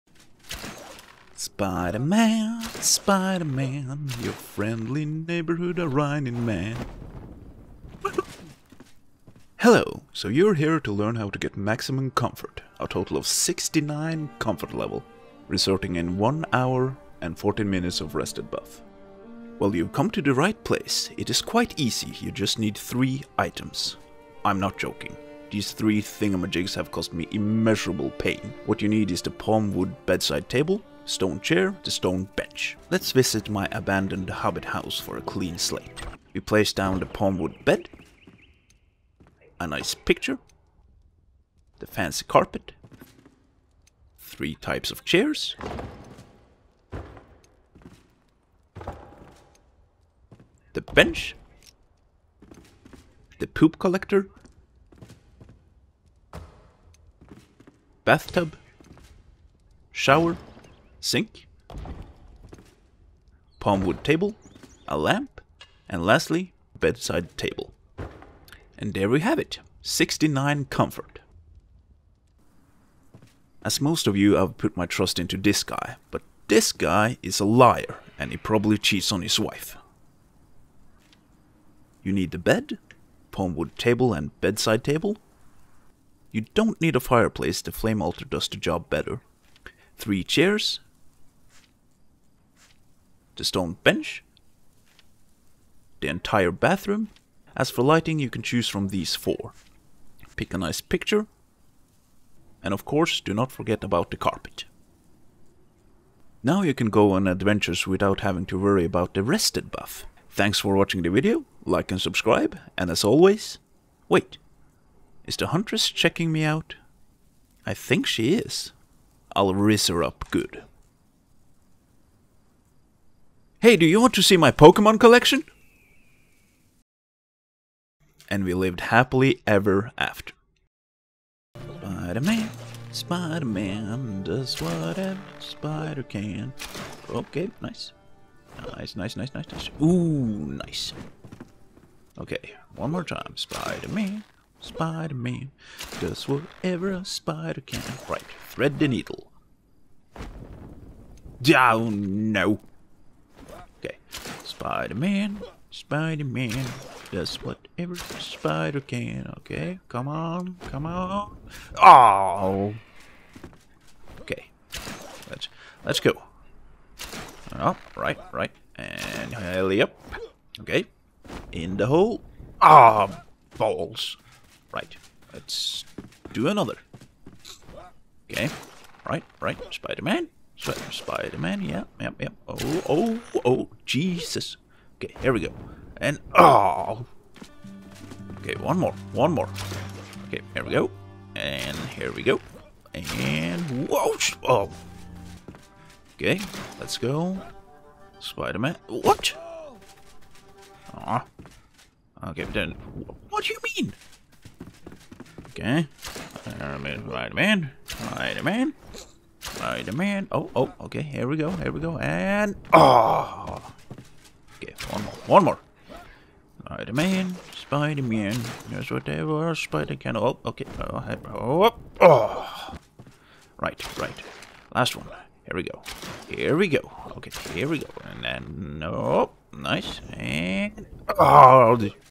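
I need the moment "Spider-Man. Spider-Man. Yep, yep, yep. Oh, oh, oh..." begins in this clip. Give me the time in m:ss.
2:59.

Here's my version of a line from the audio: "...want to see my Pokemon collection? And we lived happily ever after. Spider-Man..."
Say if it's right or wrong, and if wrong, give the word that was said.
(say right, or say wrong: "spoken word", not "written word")
right.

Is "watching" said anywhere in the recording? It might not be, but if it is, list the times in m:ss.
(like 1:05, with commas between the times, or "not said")
1:50.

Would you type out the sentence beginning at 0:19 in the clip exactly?
Well, you've come to the right place.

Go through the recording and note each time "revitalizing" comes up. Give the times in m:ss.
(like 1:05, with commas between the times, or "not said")
not said.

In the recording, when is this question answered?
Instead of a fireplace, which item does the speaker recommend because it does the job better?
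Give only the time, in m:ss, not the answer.
1:27.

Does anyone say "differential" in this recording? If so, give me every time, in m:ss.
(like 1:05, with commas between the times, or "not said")
not said.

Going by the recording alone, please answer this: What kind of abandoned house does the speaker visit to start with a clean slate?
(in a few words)
hobbit house.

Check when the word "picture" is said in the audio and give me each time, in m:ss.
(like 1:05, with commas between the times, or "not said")
0:39, 1:40.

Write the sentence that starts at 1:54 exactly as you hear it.
Wait, is the huntress checking me out?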